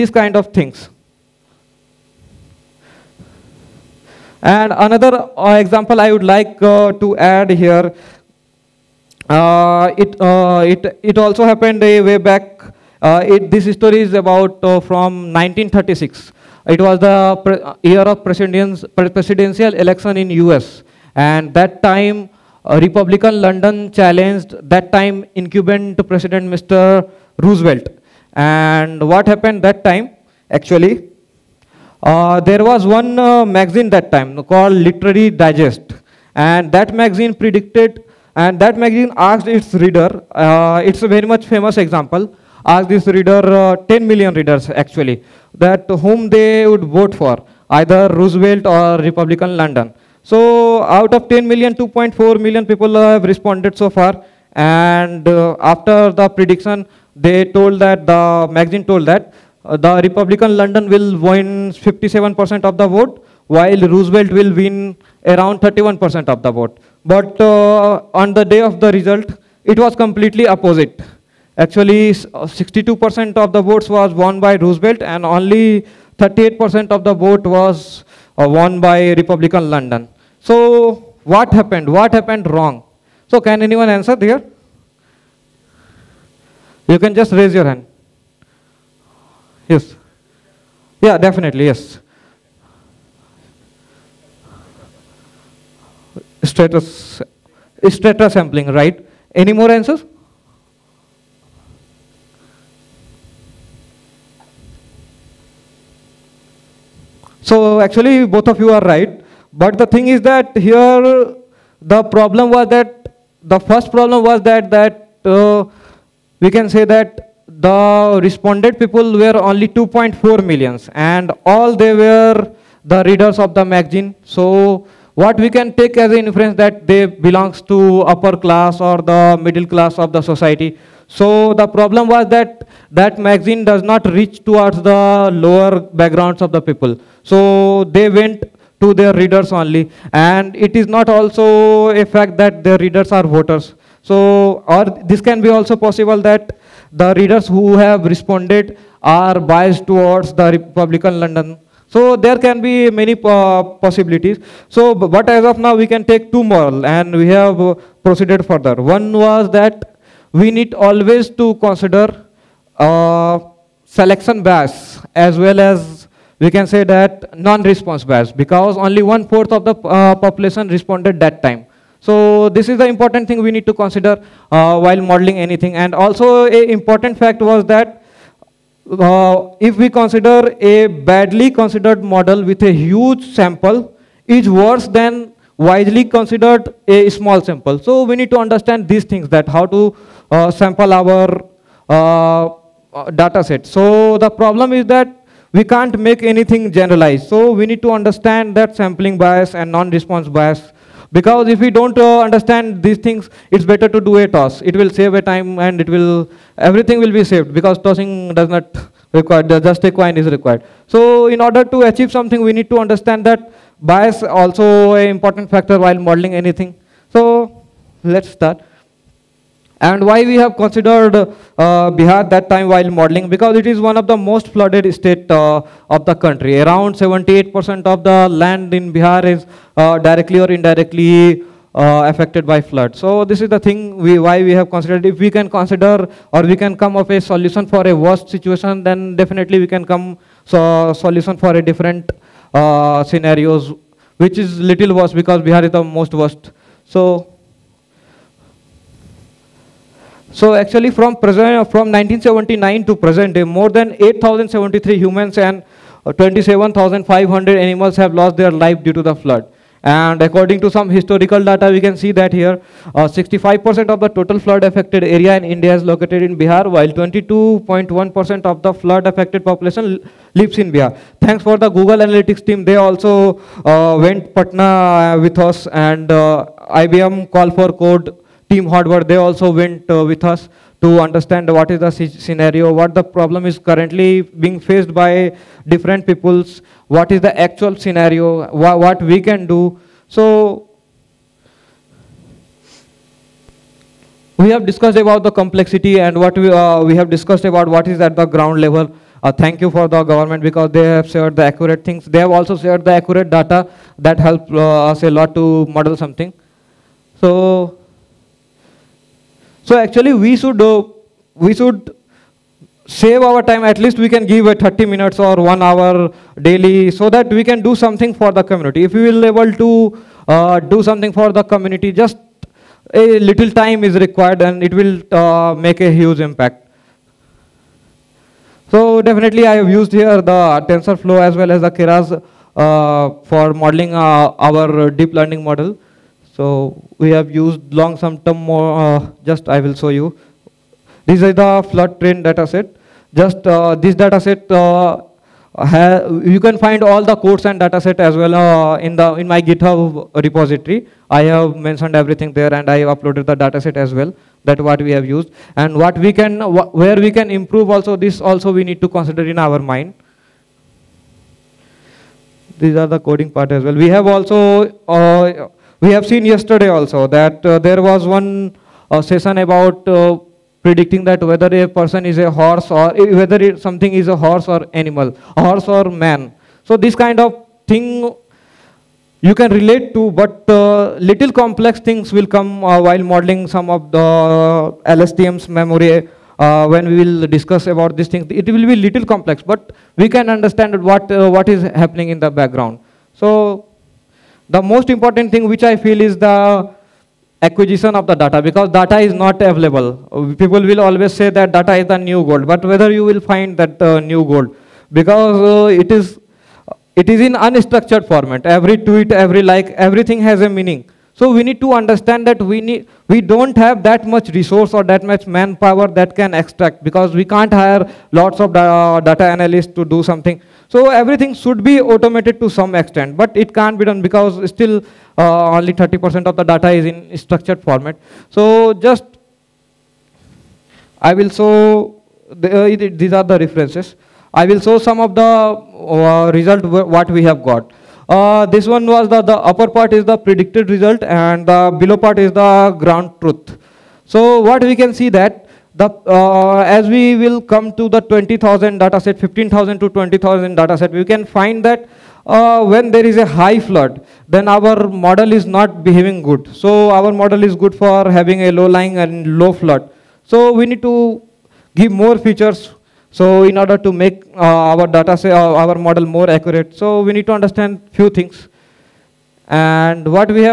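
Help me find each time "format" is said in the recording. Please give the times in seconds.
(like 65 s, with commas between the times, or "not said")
408 s, 427 s.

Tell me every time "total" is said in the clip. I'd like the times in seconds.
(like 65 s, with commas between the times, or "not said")
264 s.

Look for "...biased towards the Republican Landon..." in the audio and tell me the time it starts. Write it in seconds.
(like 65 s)
149 s.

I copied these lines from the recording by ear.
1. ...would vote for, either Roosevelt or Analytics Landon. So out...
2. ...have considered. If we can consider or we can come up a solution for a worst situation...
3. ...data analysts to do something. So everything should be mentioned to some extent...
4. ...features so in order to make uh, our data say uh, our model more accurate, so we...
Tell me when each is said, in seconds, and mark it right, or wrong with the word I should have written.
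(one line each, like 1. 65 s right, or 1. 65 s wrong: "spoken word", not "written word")
1. 46 s wrong: "Republican", not "Analytics"
2. 234 s right
3. 418 s wrong: "automated", not "mentioned"
4. 462 s right.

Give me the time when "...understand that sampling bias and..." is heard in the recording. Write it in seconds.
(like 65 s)
197 s.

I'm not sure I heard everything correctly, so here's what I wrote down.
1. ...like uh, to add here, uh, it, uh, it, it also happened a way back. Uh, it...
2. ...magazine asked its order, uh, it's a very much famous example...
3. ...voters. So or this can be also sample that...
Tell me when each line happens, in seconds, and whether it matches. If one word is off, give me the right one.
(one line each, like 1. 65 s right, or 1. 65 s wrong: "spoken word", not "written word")
1. 6 s right
2. 38 s wrong: "reader", not "order"
3. 143 s wrong: "possible", not "sample".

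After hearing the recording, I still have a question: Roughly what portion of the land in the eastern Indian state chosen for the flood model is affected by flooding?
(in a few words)
78%.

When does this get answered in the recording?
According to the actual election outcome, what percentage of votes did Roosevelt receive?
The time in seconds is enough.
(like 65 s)
72 s.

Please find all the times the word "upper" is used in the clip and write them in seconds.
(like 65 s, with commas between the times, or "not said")
128 s, 439 s.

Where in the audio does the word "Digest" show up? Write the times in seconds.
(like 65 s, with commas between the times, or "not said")
35 s.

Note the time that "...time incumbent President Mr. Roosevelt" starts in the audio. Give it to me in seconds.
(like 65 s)
24 s.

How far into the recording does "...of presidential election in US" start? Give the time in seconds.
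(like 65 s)
17 s.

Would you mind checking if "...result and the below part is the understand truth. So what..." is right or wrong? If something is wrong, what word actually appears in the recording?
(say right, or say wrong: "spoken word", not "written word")
wrong: "ground", not "understand".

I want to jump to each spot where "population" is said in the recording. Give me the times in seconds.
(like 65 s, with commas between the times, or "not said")
170 s, 269 s.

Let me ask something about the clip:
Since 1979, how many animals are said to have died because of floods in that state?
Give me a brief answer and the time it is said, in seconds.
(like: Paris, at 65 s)
27,500, at 256 s.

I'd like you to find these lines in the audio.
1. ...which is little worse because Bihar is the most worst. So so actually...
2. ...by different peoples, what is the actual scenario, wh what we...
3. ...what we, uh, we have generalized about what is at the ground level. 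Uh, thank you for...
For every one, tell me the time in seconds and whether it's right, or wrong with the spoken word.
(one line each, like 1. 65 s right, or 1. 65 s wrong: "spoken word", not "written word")
1. 244 s right
2. 284 s right
3. 296 s wrong: "discussed", not "generalized".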